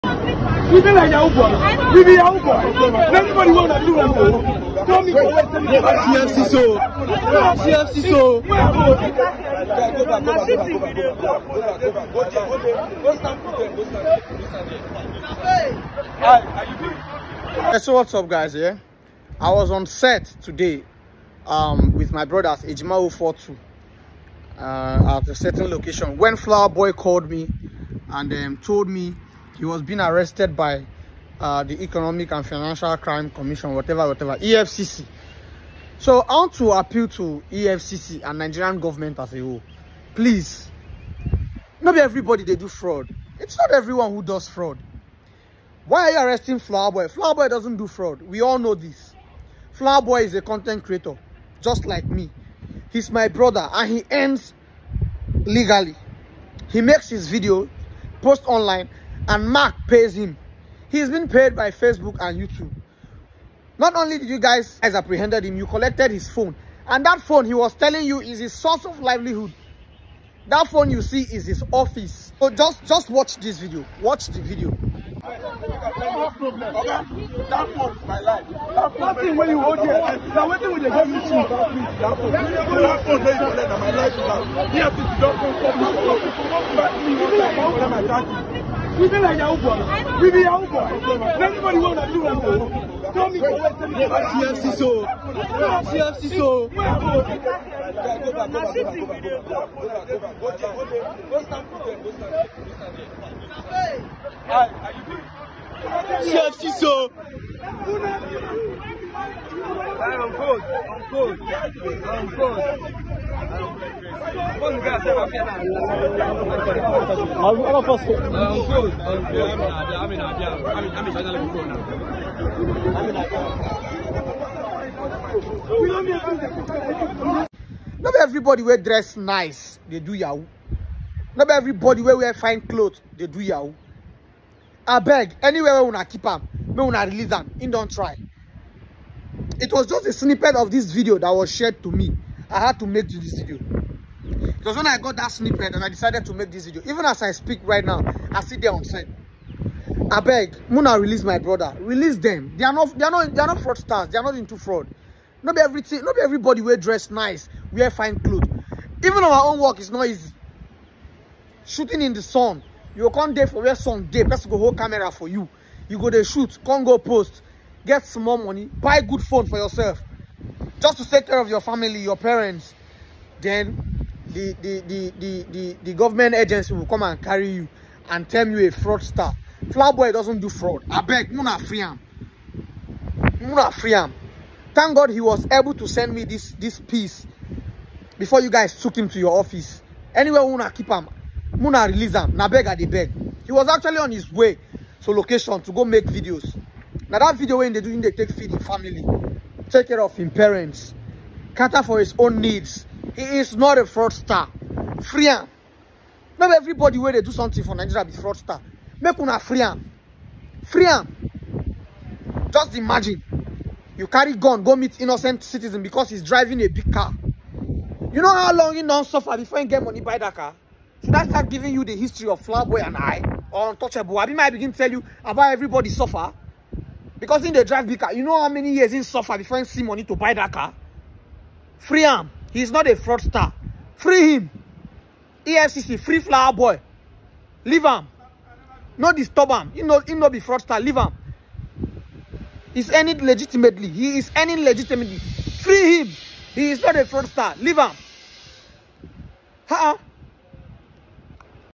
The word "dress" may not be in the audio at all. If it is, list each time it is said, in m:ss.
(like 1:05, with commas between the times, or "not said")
2:08, 2:36.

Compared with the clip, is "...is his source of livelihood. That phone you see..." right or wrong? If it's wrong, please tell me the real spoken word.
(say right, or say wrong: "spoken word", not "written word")
right.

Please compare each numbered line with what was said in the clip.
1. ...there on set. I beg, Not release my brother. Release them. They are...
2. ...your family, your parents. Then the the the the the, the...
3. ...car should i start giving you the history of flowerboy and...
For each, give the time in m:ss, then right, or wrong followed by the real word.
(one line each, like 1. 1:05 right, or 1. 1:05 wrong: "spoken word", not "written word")
1. 2:28 wrong: "Muna", not "Not"
2. 2:51 right
3. 3:40 right.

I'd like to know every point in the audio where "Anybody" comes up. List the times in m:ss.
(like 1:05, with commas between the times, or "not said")
0:03, 1:31.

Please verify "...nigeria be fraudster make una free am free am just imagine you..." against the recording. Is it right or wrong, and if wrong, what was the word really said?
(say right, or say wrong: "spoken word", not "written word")
right.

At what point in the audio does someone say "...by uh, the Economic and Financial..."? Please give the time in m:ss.
0:30.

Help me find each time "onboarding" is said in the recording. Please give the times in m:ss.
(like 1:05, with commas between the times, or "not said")
not said.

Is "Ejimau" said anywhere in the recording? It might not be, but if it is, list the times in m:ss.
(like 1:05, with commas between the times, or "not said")
0:22.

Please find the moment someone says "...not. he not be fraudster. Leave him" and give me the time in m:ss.
3:59.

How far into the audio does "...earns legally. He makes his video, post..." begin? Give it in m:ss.
0:54.